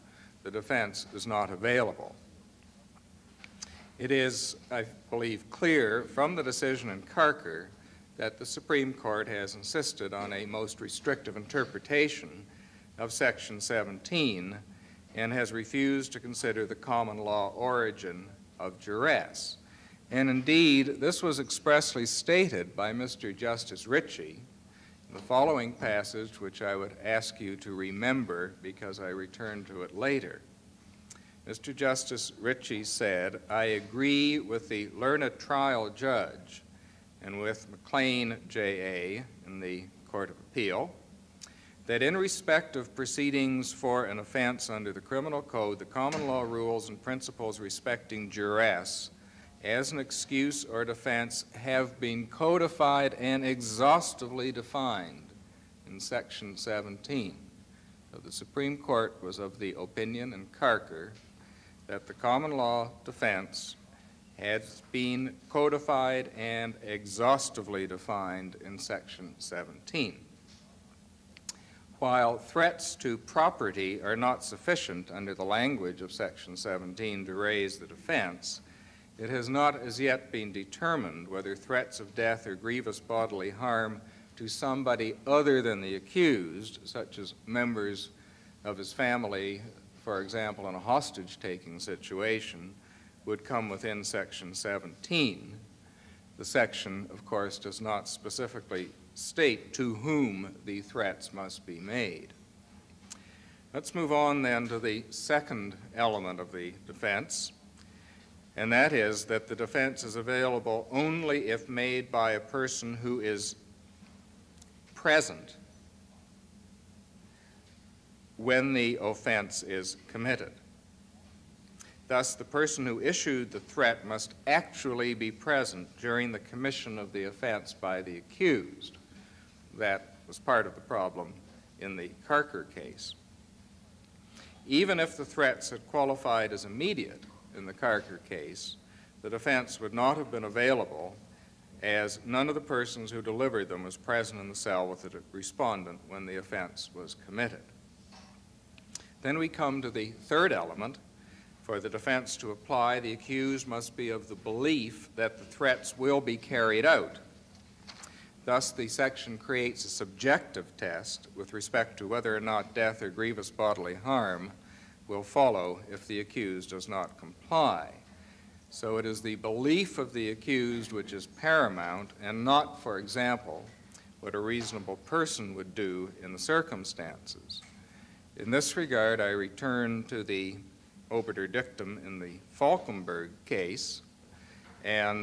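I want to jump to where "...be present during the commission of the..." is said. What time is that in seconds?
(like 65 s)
125 s.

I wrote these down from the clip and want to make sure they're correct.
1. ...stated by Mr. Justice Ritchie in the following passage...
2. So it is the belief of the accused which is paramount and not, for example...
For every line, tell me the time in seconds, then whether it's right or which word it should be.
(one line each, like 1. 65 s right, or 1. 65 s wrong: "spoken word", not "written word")
1. 22 s right
2. 168 s right.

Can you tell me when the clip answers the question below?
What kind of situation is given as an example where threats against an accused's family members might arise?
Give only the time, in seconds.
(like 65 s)
90 s.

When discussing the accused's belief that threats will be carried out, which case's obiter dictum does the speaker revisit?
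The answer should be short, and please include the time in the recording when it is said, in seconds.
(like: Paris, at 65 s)
Falkenberg, at 182 s.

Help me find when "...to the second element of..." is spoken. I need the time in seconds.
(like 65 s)
104 s.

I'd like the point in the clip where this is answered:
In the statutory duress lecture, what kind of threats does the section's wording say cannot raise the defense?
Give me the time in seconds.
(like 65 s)
72 s.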